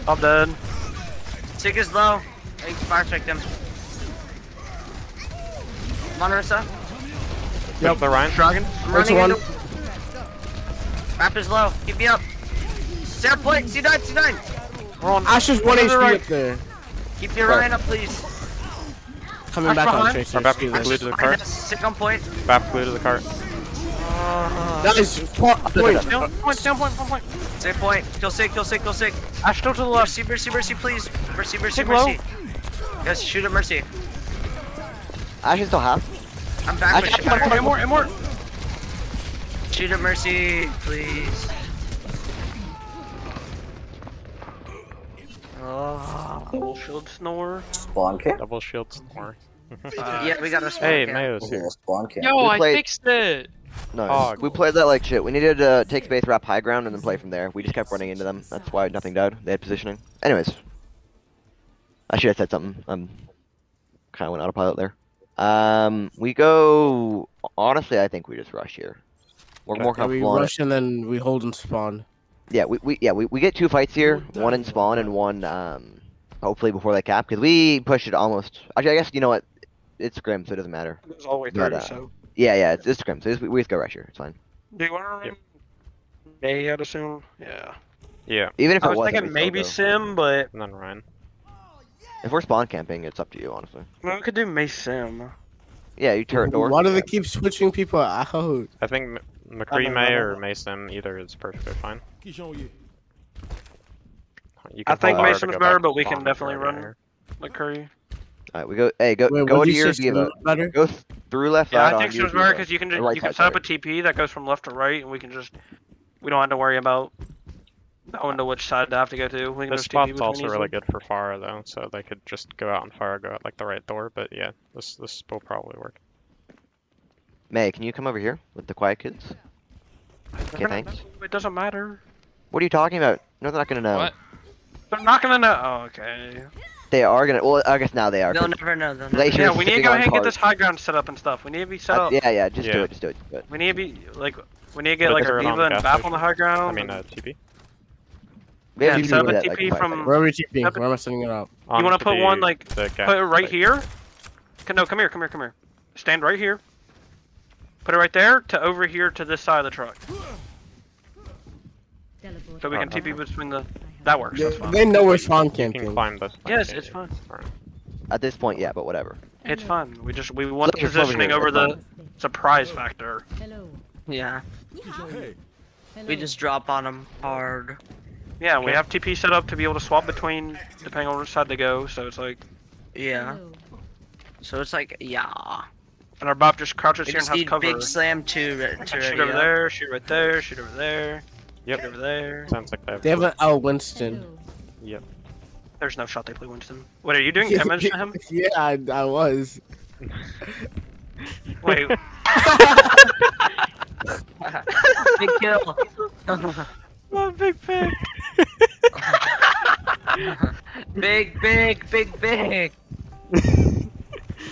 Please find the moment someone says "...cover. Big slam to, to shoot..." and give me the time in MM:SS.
03:07.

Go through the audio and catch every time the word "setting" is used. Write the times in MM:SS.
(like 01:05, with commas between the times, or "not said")
02:30.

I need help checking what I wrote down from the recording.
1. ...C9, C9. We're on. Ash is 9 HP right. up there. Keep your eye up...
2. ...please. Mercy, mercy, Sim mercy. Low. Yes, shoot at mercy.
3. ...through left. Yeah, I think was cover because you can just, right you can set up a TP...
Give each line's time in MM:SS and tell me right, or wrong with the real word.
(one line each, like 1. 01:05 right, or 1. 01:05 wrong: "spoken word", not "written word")
1. 00:13 wrong: "1", not "9"
2. 00:30 wrong: "Take", not "Sim"
3. 01:51 wrong: "better", not "cover".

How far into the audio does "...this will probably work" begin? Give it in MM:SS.
02:04.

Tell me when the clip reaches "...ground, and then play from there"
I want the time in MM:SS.
00:56.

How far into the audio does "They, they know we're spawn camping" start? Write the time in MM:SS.
02:44.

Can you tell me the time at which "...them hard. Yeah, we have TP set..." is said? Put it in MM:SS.
02:56.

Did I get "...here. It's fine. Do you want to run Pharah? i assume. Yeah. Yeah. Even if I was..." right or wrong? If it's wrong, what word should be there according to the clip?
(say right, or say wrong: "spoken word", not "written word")
wrong: "Mei", not "Pharah".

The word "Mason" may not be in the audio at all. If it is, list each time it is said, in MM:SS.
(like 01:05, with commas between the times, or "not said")
01:40, 01:45.